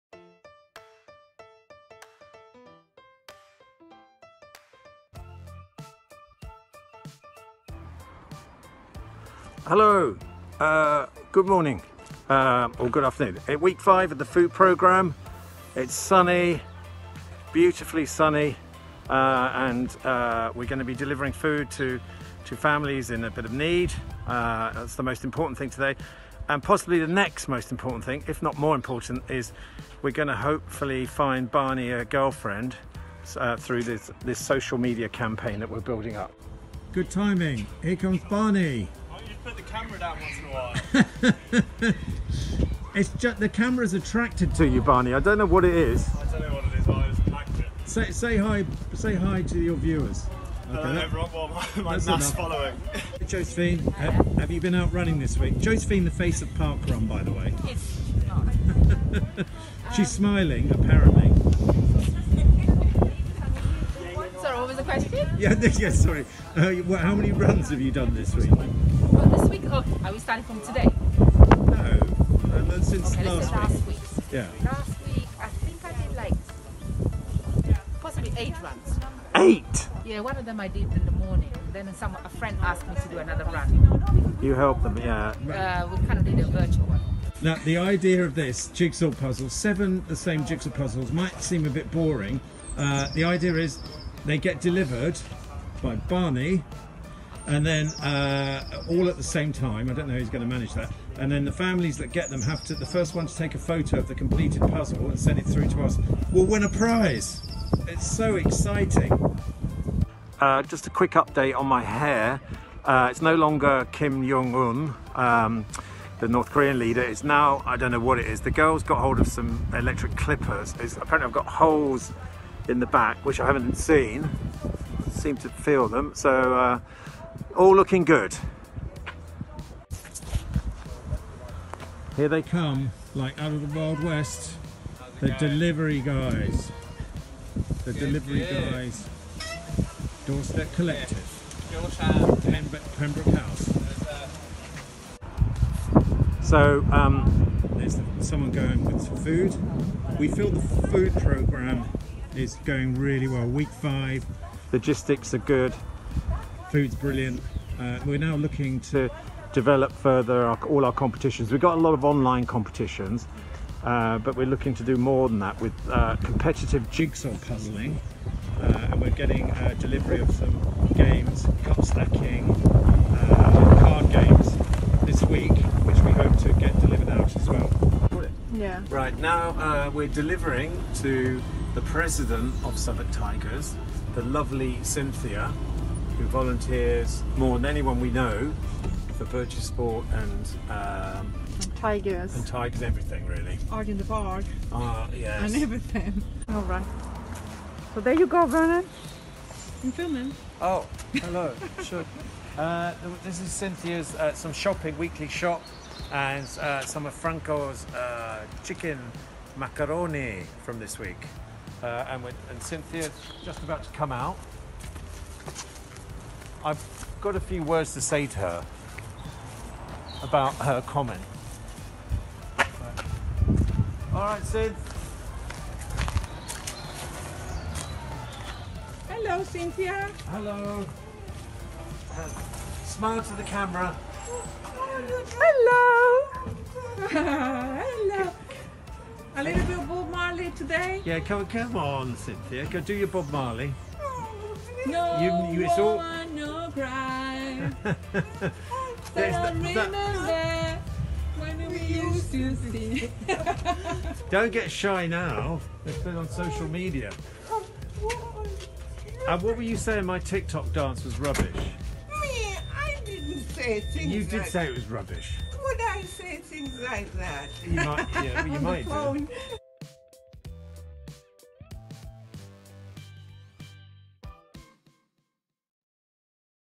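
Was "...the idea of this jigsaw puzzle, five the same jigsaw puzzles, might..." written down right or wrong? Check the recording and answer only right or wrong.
wrong.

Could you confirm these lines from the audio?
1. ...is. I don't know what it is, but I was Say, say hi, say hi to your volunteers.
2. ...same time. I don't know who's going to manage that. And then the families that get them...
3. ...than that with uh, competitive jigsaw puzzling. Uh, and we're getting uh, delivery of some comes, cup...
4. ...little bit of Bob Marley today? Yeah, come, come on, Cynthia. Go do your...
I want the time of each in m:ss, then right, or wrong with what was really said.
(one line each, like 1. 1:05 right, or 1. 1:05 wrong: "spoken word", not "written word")
1. 0:45 wrong: "viewers", not "volunteers"
2. 1:39 right
3. 2:45 wrong: "games", not "comes"
4. 3:59 right.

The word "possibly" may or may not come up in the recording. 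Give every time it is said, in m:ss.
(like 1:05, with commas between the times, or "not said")
0:26, 1:18.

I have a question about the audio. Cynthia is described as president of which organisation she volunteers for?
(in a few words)
Southwark Tigers.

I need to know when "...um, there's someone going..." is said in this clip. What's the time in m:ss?
2:26.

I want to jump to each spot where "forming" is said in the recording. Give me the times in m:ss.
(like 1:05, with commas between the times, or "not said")
not said.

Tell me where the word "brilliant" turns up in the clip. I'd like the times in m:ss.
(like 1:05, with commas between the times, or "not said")
2:36.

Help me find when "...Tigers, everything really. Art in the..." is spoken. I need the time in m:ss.
3:12.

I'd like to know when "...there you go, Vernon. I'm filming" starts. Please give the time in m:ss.
3:18.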